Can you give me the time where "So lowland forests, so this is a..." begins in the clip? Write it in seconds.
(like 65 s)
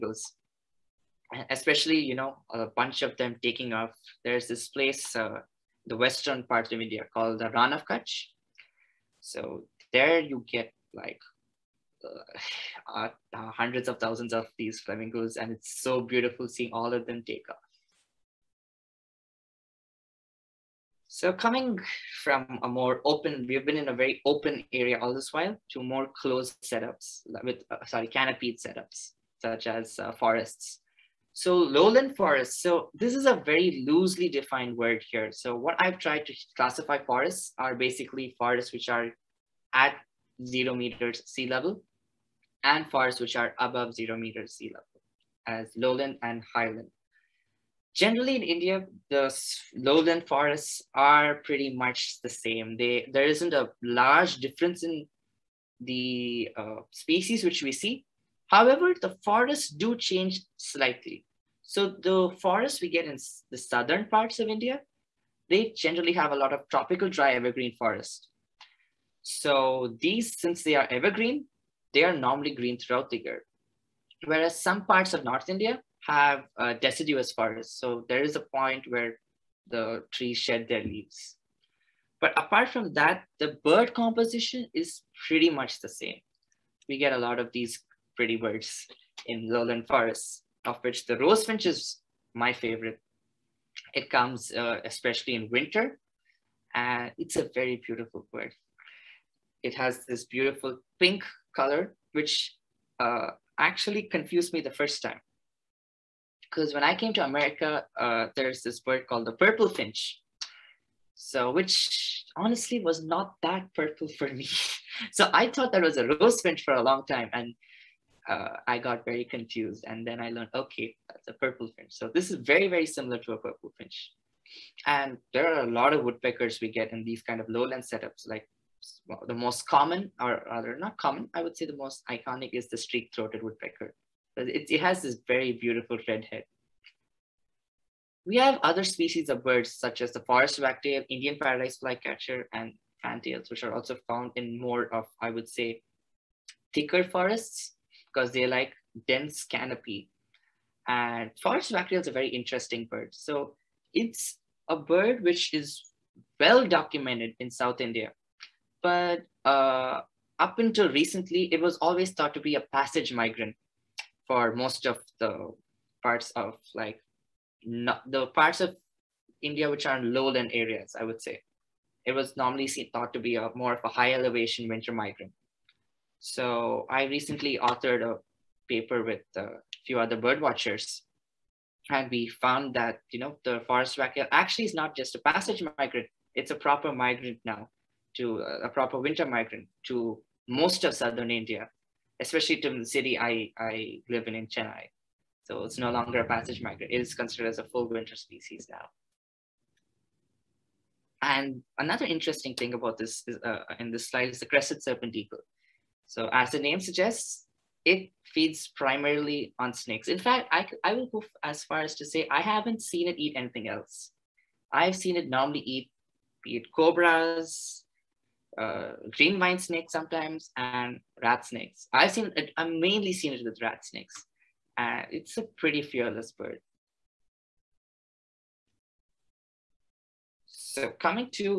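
31 s.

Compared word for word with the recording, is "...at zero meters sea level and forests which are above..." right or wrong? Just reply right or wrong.
right.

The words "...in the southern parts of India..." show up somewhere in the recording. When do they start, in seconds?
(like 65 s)
63 s.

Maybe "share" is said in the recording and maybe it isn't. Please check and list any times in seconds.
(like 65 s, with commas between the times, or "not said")
not said.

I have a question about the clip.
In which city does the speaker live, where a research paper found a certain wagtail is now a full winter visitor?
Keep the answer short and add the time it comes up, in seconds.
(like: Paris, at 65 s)
Chennai, at 194 s.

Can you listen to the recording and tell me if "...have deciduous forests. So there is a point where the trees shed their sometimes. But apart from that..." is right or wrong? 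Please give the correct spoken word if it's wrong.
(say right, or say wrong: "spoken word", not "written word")
wrong: "leaves", not "sometimes".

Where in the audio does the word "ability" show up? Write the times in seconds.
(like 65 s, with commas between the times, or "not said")
not said.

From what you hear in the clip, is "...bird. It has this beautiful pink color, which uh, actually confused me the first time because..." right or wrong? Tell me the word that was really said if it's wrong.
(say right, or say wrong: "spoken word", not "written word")
right.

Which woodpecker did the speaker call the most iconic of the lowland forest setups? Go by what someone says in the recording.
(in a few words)
streak-throated woodpecker.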